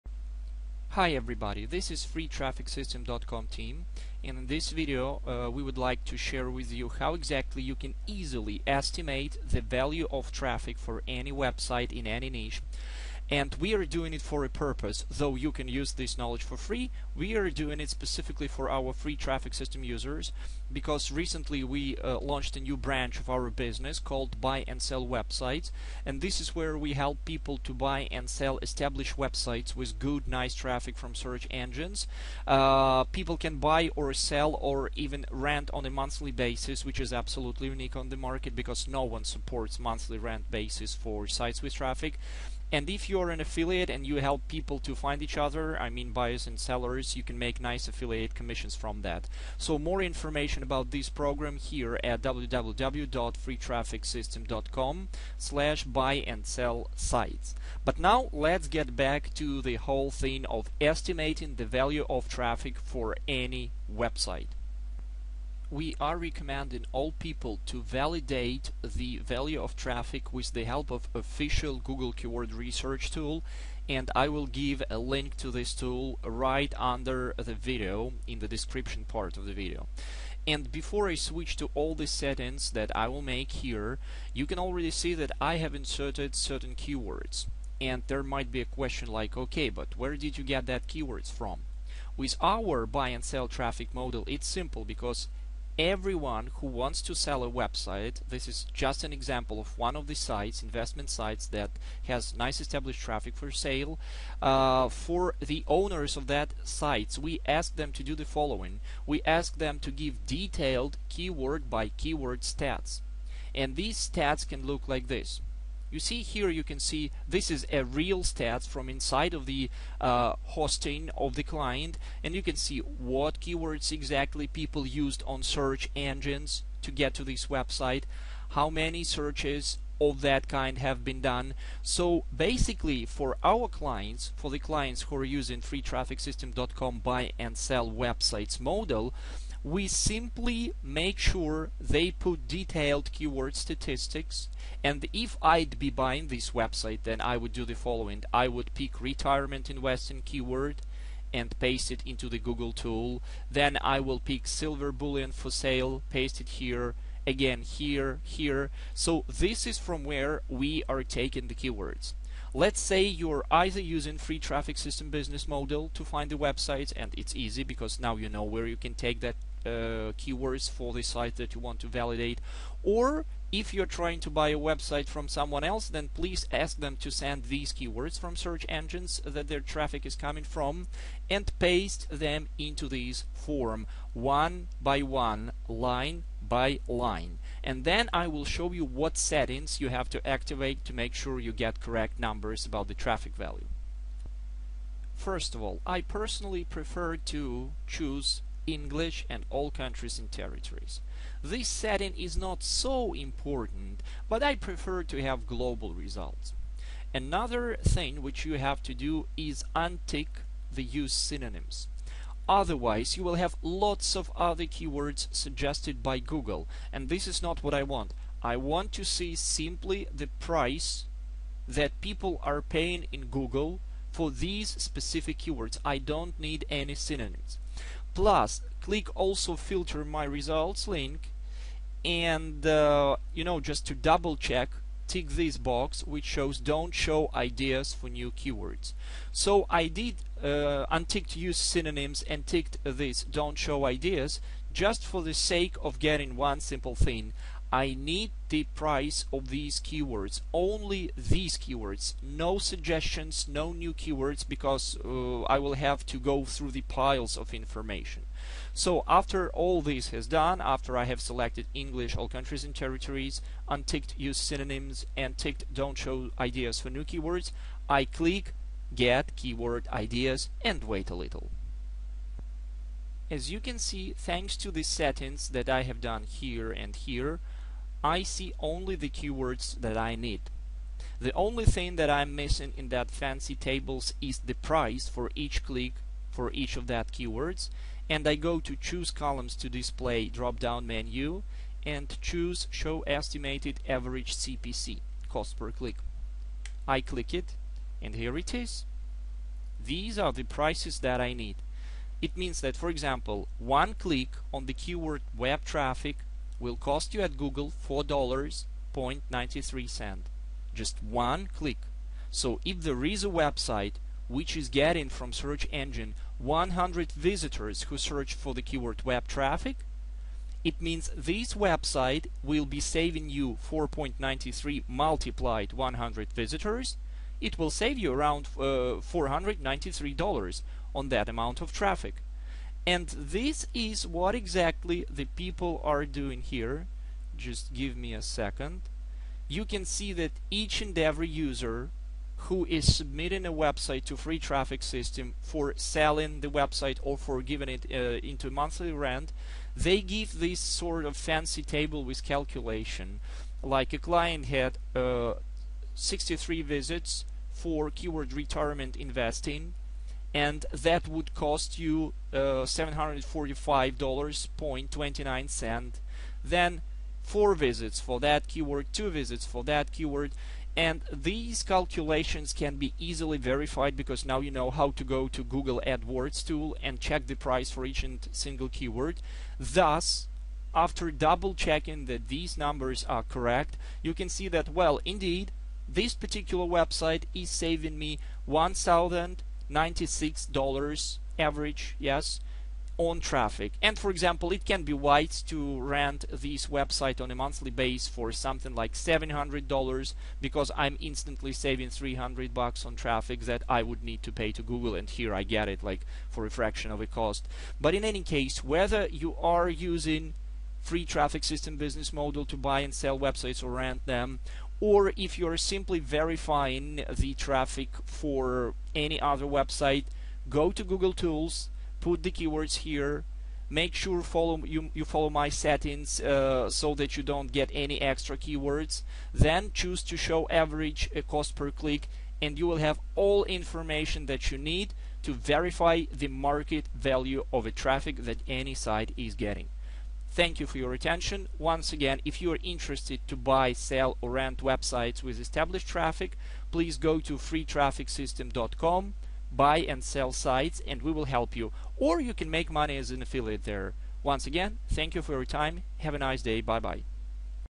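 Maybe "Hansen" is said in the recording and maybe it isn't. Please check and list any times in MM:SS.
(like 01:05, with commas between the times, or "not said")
not said.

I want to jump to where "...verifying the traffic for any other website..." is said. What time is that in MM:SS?
06:55.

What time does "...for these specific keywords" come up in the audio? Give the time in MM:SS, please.
03:44.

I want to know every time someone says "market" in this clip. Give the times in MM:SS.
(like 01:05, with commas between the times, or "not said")
00:38, 07:16.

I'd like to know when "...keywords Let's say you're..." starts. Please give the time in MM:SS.
02:41.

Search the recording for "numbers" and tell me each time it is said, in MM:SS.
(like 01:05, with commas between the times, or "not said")
03:12, 06:22.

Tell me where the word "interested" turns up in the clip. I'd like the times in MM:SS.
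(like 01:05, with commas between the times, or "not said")
07:22.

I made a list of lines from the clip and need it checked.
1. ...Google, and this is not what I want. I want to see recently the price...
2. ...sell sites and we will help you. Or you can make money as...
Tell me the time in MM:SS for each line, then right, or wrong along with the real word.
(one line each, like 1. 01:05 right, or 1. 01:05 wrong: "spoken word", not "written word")
1. 03:36 wrong: "simply", not "recently"
2. 07:30 right.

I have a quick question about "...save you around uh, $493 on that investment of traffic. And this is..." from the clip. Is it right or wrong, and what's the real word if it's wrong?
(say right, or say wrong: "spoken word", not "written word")
wrong: "amount", not "investment".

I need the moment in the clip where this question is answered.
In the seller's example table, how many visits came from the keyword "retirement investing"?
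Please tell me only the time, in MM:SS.
05:55.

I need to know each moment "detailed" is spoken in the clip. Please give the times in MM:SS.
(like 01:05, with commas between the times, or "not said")
01:50, 02:22.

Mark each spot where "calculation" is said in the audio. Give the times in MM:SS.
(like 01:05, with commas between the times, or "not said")
05:52, 06:11.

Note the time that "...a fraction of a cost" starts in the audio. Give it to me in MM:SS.
06:46.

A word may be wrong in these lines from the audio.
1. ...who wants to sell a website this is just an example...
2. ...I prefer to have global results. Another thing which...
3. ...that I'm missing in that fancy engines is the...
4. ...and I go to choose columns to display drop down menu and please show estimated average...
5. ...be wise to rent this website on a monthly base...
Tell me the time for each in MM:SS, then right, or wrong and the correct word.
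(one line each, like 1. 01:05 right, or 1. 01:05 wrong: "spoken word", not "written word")
1. 01:36 right
2. 03:24 right
3. 04:41 wrong: "tables", not "engines"
4. 04:48 wrong: "choose", not "please"
5. 06:34 right.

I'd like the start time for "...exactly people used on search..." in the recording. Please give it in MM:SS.
02:03.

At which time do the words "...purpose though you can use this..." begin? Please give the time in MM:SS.
00:14.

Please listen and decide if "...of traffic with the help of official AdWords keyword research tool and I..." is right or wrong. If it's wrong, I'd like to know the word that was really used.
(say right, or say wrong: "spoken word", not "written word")
wrong: "Google", not "AdWords".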